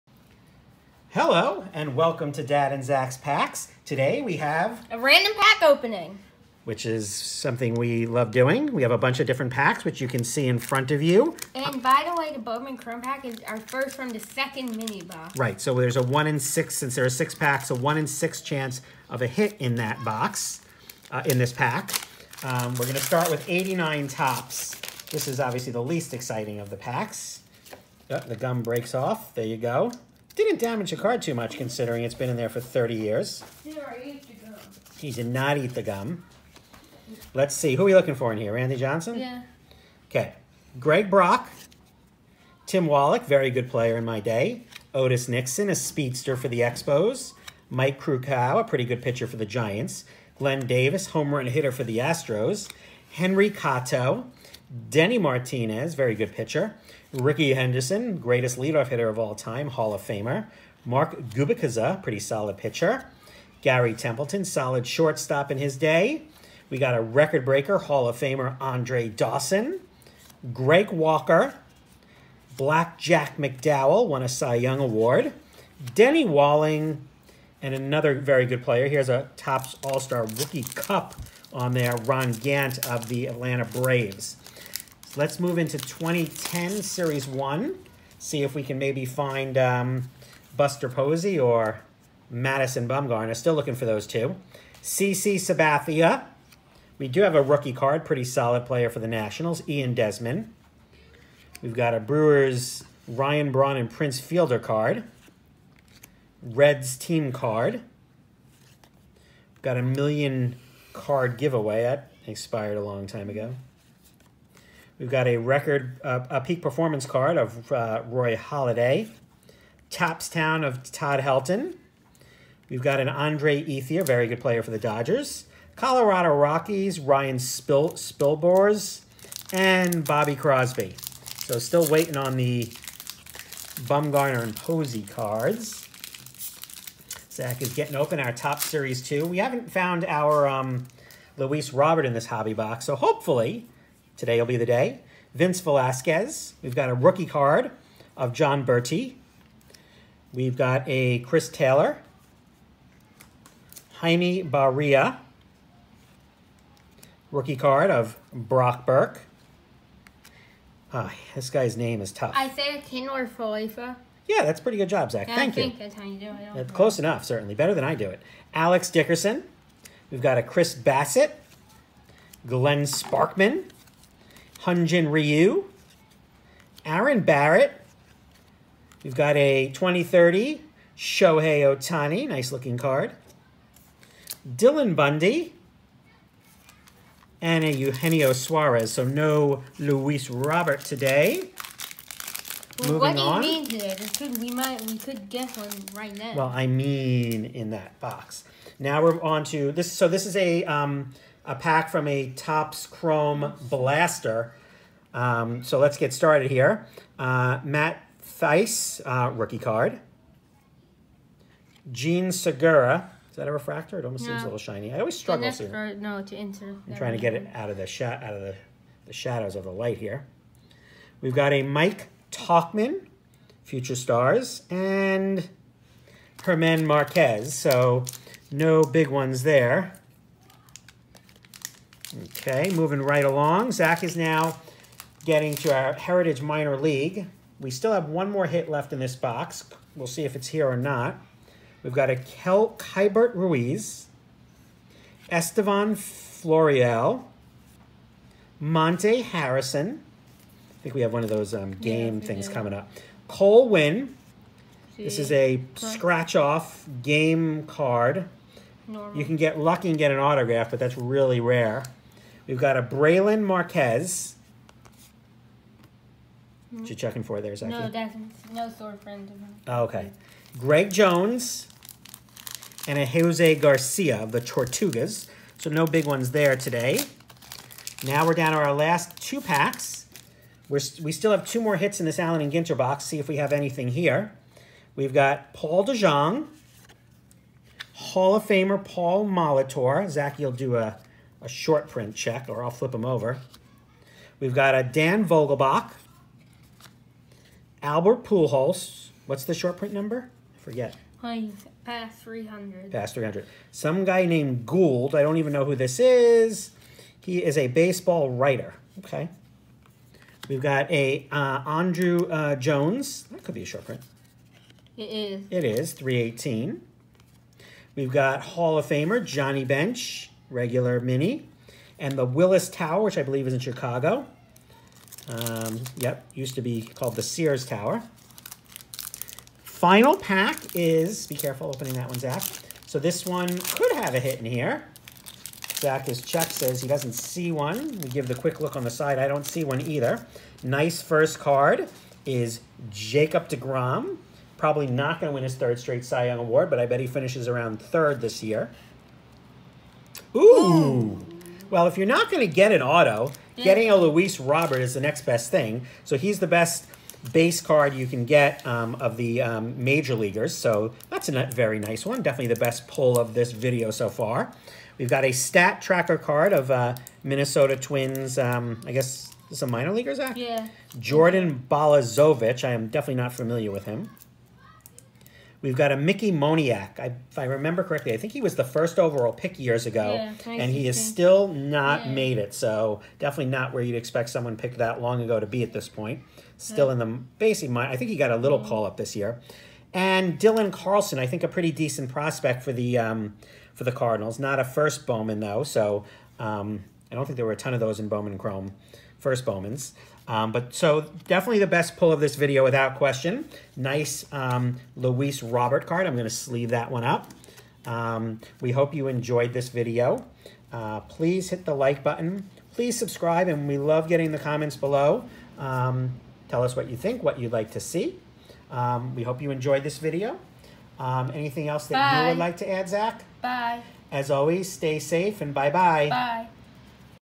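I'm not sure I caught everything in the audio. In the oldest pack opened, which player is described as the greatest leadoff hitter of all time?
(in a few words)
Ricky Henderson.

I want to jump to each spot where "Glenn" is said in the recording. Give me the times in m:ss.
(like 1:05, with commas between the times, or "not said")
0:50, 2:52.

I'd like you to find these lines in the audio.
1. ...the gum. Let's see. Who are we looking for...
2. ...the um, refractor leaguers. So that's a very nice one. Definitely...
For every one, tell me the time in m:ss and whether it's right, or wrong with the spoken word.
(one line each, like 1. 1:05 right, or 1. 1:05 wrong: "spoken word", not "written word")
1. 0:35 right
2. 5:59 wrong: "major", not "refractor".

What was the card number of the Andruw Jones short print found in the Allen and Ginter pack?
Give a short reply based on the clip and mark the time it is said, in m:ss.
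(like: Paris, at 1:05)
318, at 5:15.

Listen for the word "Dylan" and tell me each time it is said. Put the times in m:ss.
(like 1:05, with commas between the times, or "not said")
3:04, 6:30.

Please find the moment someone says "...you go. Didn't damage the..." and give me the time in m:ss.
0:29.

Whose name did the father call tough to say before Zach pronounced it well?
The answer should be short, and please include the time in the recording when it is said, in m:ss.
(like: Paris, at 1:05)
Isiah Kiner-Falefa, at 2:42.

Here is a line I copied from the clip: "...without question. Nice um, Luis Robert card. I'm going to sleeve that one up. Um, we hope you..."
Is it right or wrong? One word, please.
right.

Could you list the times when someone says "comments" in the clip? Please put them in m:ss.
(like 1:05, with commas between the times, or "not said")
6:54.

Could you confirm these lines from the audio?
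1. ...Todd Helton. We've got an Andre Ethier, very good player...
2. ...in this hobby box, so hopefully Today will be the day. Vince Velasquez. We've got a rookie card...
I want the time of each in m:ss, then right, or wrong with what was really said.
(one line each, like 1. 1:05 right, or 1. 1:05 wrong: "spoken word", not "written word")
1. 2:00 right
2. 2:22 right.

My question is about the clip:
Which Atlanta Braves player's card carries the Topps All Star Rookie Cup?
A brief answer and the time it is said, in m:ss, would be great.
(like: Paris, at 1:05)
Ron Gant, at 1:22.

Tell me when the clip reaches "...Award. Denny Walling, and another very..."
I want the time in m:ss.
1:14.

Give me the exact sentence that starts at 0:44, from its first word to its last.
Otis Nixon, a speedster for the Expos.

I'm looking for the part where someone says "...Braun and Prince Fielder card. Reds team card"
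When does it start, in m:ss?
1:43.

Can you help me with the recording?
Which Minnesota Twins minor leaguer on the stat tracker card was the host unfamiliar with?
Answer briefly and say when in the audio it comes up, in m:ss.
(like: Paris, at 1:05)
Jordan Balazovic, at 6:10.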